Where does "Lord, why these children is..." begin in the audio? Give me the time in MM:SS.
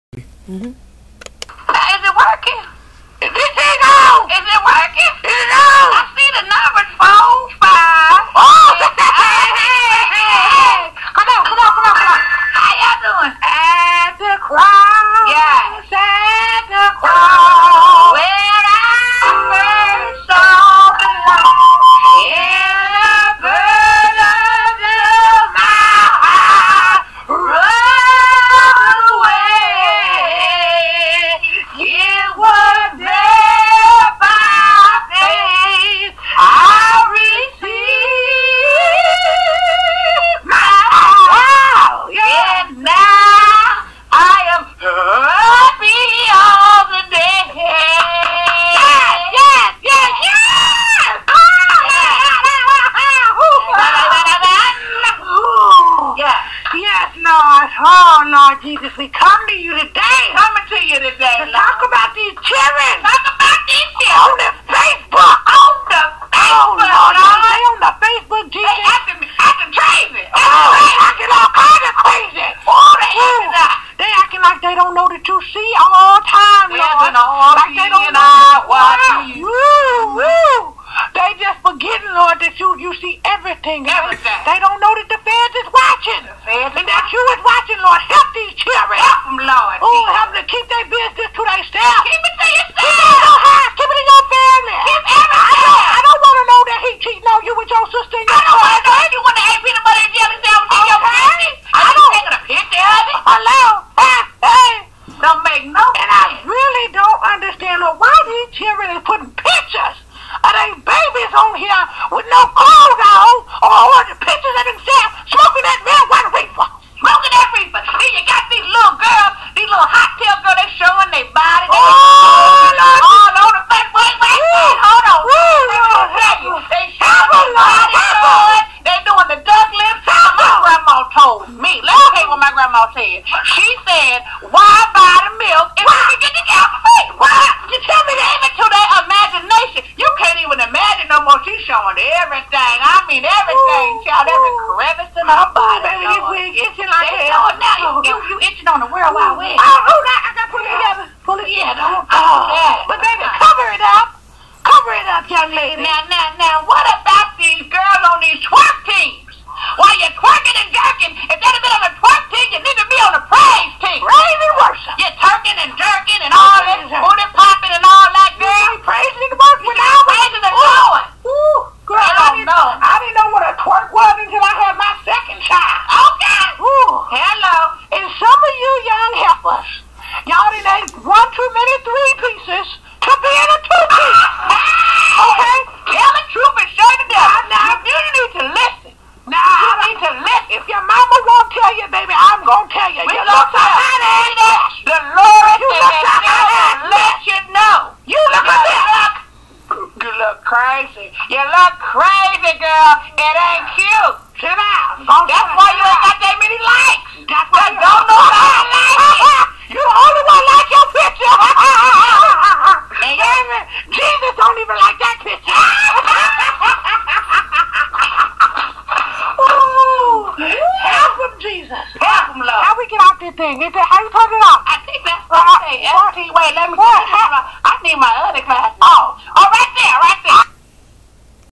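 01:47.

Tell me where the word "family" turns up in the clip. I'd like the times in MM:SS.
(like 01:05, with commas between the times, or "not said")
01:34, 01:41.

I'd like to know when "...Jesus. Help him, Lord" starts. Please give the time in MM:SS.
03:41.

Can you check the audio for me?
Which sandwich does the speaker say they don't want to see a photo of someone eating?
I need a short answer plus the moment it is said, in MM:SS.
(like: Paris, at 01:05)
Peanut butter and jelly, at 01:39.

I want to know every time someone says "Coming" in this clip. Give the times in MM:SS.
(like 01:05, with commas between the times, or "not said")
01:00.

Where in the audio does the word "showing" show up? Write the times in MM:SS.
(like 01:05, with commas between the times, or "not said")
02:21.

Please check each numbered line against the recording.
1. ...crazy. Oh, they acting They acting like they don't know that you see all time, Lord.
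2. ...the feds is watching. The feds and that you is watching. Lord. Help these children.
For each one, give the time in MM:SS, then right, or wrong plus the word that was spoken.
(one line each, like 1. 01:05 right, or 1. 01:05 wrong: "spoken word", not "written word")
1. 01:12 right
2. 01:25 right.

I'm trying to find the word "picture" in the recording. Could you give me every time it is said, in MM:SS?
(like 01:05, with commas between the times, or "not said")
01:42, 03:30, 03:35.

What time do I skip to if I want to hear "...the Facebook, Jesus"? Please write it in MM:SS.
01:07.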